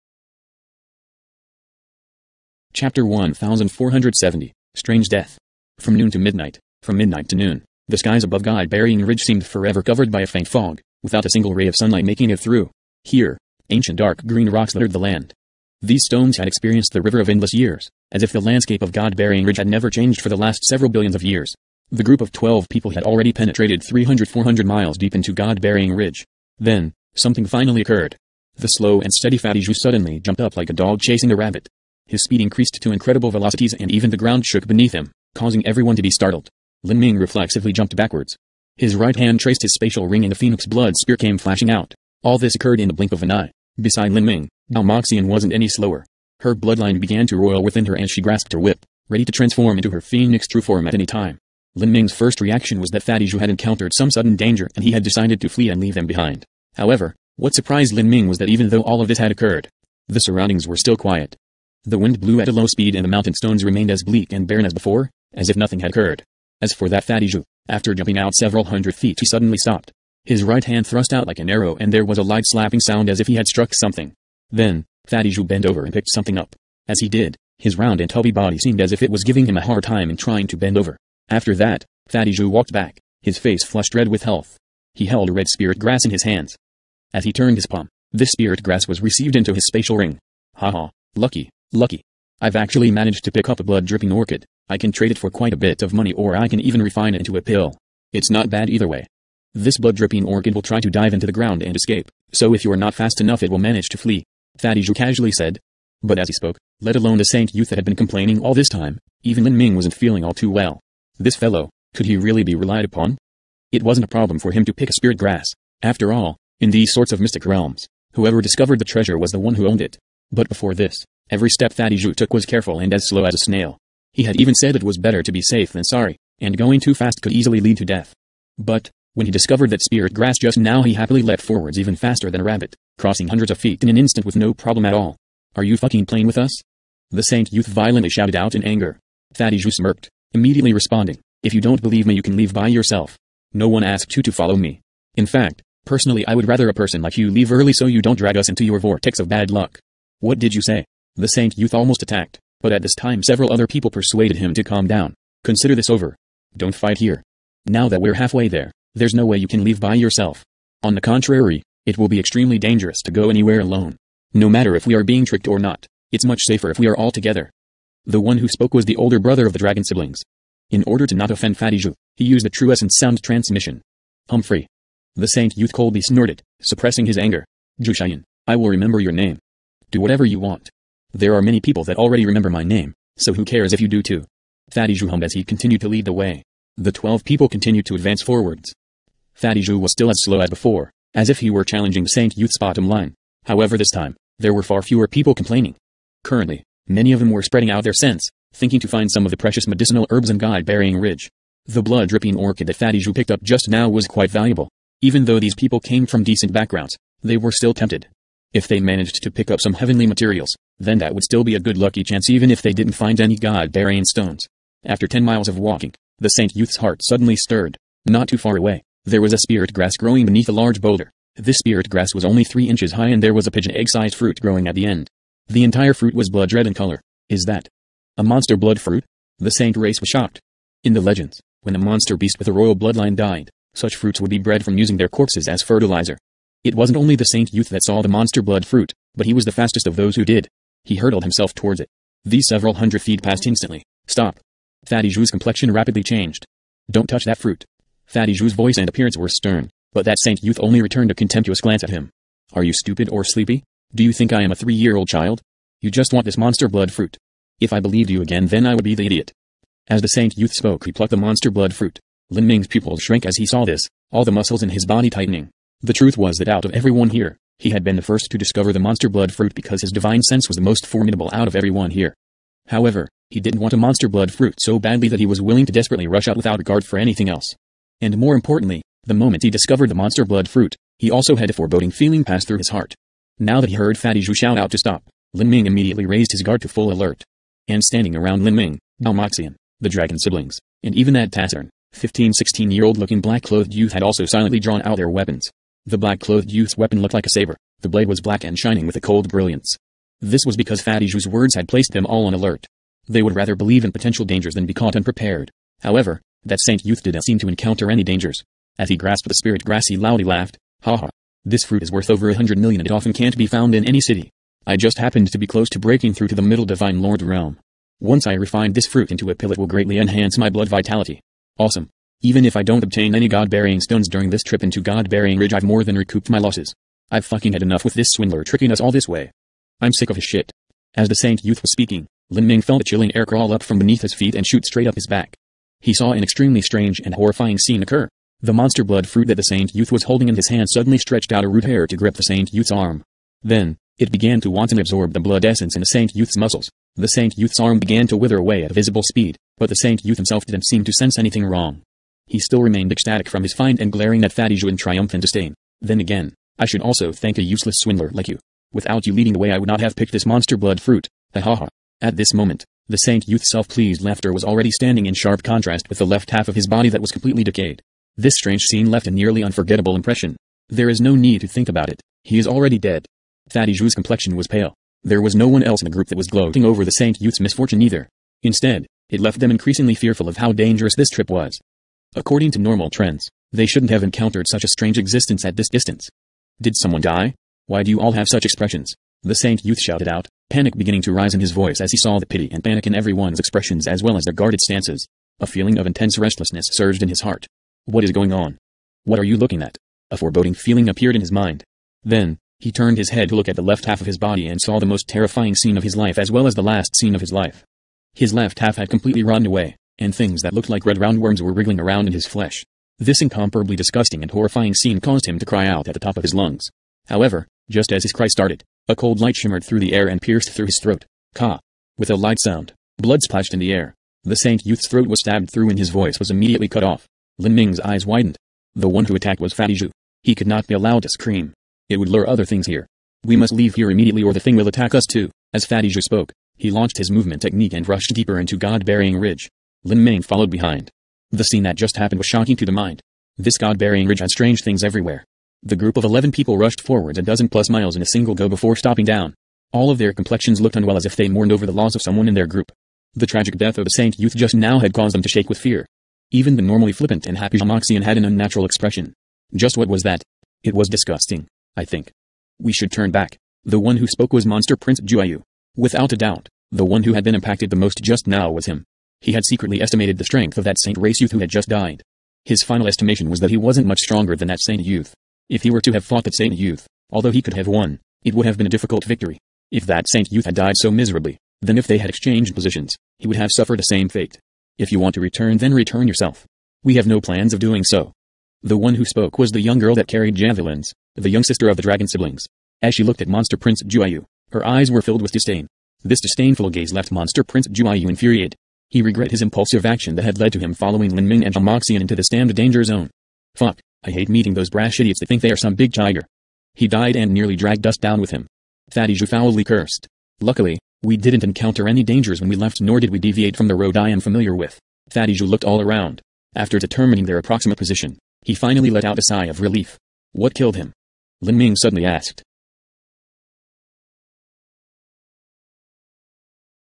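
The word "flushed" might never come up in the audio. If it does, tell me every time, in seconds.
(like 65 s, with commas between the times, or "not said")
83 s.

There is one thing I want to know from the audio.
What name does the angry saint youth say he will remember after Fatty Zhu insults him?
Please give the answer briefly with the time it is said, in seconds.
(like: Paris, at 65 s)
Jushayan, at 177 s.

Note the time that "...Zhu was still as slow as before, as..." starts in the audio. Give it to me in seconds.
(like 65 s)
189 s.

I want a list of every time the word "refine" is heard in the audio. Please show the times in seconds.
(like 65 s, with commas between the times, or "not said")
96 s, 318 s.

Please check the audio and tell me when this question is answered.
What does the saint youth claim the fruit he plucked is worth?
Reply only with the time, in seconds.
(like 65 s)
312 s.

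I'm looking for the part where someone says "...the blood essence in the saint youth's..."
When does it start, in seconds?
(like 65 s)
345 s.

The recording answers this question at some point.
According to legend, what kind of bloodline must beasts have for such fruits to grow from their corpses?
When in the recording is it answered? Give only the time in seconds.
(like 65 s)
232 s.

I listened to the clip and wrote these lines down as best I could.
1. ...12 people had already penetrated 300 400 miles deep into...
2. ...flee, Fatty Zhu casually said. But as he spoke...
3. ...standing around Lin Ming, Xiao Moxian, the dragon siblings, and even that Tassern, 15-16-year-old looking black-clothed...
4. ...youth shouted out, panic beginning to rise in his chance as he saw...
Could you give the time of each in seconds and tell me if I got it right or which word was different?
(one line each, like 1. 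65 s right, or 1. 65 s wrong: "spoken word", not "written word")
1. 22 s right
2. 103 s right
3. 287 s right
4. 389 s wrong: "voice", not "chance".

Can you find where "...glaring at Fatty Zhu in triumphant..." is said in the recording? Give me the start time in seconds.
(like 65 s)
353 s.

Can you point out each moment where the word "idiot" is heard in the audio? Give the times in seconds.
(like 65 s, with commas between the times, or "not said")
259 s, 504 s.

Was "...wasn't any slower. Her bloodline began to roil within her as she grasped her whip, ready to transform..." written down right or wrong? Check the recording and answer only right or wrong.
right.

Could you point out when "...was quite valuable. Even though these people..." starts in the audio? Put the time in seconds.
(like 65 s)
203 s.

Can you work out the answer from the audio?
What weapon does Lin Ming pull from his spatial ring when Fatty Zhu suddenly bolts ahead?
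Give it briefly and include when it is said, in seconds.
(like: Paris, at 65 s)
phoenix blood spear, at 40 s.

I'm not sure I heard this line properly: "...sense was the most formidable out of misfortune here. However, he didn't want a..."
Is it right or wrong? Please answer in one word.
wrong.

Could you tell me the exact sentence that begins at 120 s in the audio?
But before this, Every step Fatty Zhu took was careful and as slow as a snail.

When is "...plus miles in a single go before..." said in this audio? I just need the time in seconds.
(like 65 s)
447 s.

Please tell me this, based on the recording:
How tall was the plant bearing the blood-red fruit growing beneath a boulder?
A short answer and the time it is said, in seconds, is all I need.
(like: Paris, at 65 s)
3 inches, at 222 s.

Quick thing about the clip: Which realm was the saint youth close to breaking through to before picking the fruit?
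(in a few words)
middle divine lord realm.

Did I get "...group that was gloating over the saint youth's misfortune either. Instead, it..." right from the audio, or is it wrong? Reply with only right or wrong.
right.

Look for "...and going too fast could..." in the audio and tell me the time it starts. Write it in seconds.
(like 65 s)
126 s.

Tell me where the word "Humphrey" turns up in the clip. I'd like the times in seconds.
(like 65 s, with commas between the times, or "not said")
174 s.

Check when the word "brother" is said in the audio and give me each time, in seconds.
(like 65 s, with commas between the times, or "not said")
169 s.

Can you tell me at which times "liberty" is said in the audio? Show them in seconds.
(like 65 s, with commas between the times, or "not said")
not said.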